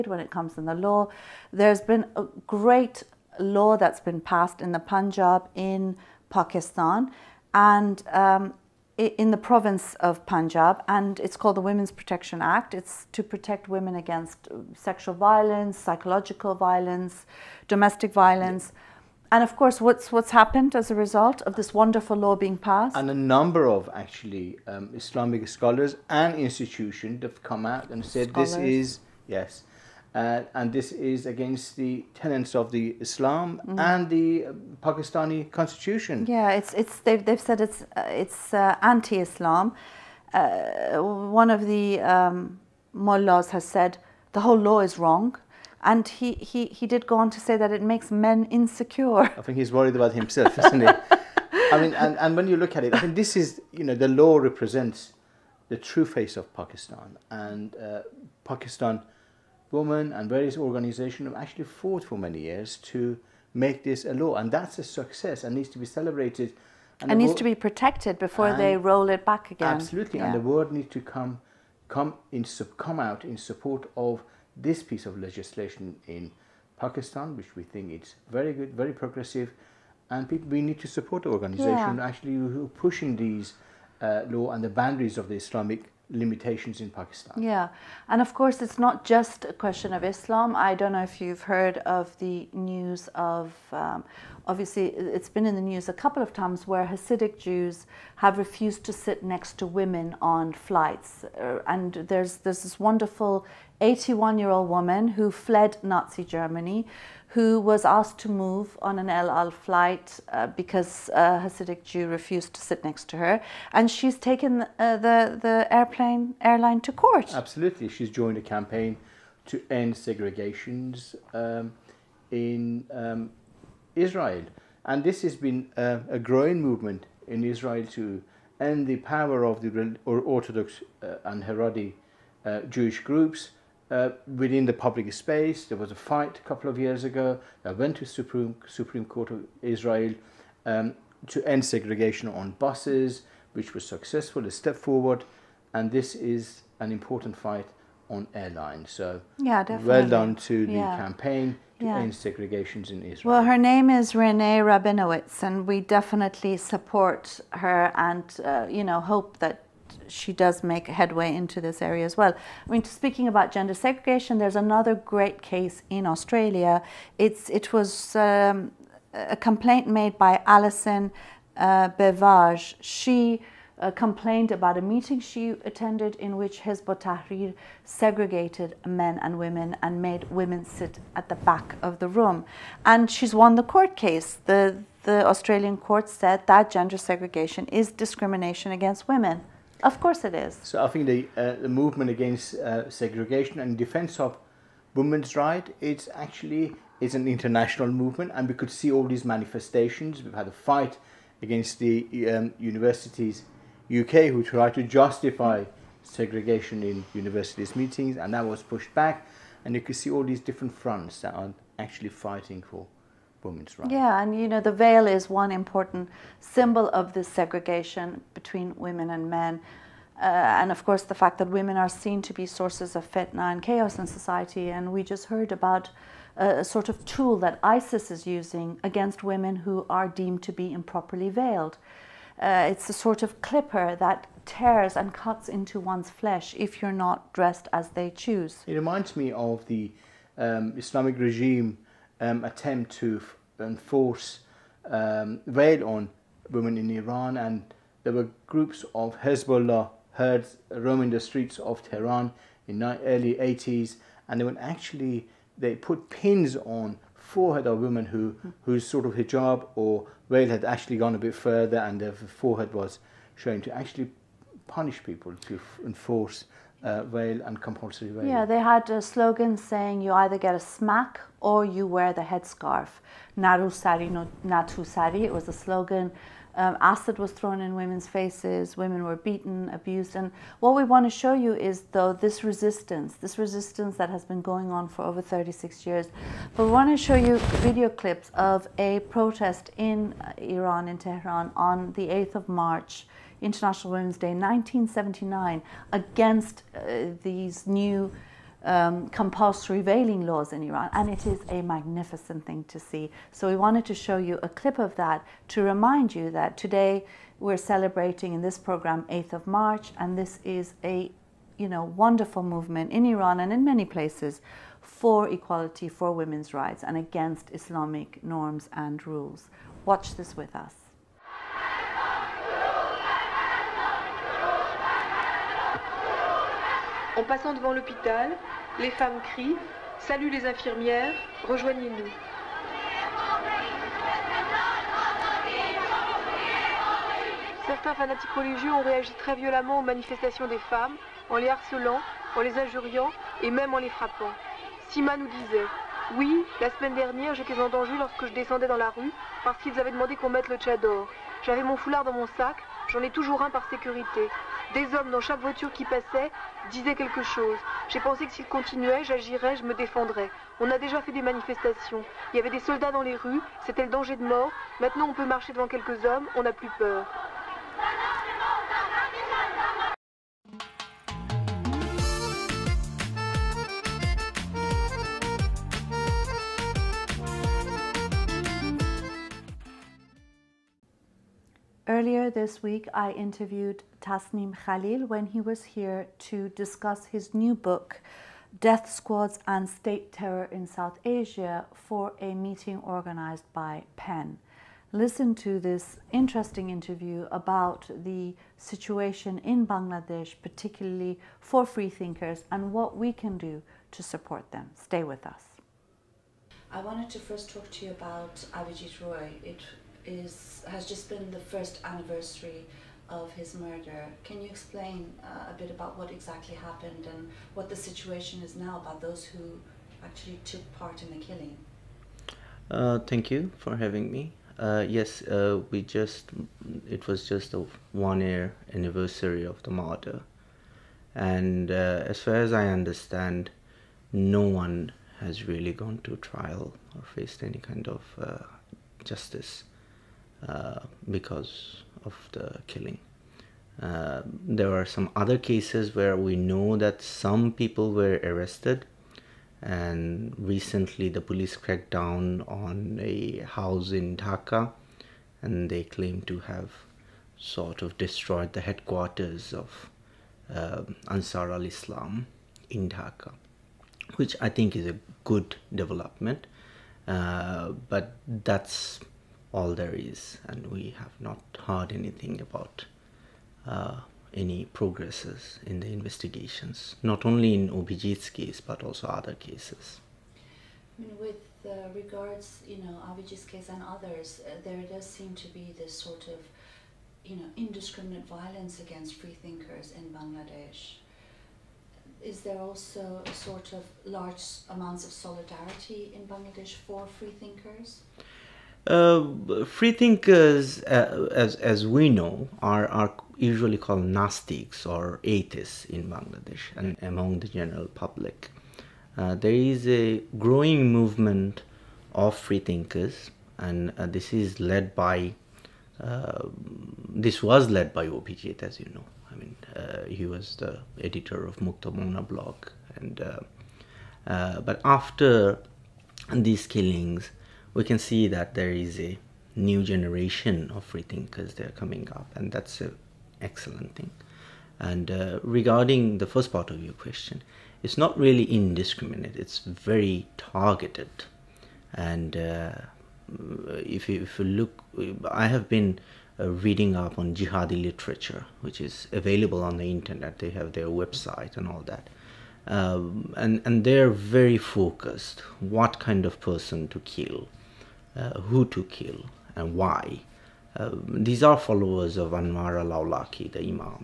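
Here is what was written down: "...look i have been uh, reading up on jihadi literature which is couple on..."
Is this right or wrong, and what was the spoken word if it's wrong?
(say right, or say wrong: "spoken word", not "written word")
wrong: "available", not "couple".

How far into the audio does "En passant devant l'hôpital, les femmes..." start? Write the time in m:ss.
5:27.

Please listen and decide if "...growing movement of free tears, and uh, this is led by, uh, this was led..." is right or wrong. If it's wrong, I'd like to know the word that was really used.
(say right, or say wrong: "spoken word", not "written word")
wrong: "thinkers", not "tears".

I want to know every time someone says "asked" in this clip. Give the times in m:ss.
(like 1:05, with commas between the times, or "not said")
1:47.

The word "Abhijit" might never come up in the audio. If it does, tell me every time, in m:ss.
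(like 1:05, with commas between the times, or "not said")
6:48, 7:57, 8:03, 8:38.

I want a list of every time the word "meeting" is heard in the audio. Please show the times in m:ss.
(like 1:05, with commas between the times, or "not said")
2:54, 3:27, 6:32.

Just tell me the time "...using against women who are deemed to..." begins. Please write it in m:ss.
3:48.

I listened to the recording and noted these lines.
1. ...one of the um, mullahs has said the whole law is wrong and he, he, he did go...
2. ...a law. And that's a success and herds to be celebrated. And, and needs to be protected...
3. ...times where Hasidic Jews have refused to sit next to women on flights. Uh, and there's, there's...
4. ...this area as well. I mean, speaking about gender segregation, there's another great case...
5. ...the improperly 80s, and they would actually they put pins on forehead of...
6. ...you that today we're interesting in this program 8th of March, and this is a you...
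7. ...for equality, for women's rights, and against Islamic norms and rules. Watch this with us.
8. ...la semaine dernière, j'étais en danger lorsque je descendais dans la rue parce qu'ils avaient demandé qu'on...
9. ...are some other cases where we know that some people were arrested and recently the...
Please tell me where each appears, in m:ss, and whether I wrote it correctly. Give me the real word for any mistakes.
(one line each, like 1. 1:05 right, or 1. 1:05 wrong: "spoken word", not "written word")
1. 0:41 right
2. 1:04 wrong: "needs", not "herds"
3. 1:36 right
4. 2:41 right
5. 4:12 wrong: "early", not "improperly"
6. 5:06 wrong: "celebrating", not "interesting"
7. 5:14 right
8. 5:46 right
9. 7:24 right.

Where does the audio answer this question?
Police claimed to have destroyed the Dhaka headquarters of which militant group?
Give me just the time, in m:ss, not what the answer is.
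7:41.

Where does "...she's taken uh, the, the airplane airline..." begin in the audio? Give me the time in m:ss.
1:53.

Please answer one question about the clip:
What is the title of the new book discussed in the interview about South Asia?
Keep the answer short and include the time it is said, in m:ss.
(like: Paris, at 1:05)
Death Squads and State Terror in South Asia, at 6:28.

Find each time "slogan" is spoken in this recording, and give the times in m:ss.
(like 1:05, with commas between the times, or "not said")
4:29, 4:35.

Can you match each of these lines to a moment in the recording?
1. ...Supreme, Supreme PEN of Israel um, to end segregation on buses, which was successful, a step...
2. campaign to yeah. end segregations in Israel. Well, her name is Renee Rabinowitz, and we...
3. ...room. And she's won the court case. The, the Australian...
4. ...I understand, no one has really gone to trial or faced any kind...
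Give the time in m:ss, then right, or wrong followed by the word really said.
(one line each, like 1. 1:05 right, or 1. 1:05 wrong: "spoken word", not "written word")
1. 2:18 wrong: "Court", not "PEN"
2. 2:30 right
3. 3:02 right
4. 7:12 right.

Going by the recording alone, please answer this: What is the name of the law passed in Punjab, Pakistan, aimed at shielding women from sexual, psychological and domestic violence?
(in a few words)
Women's Protection Act.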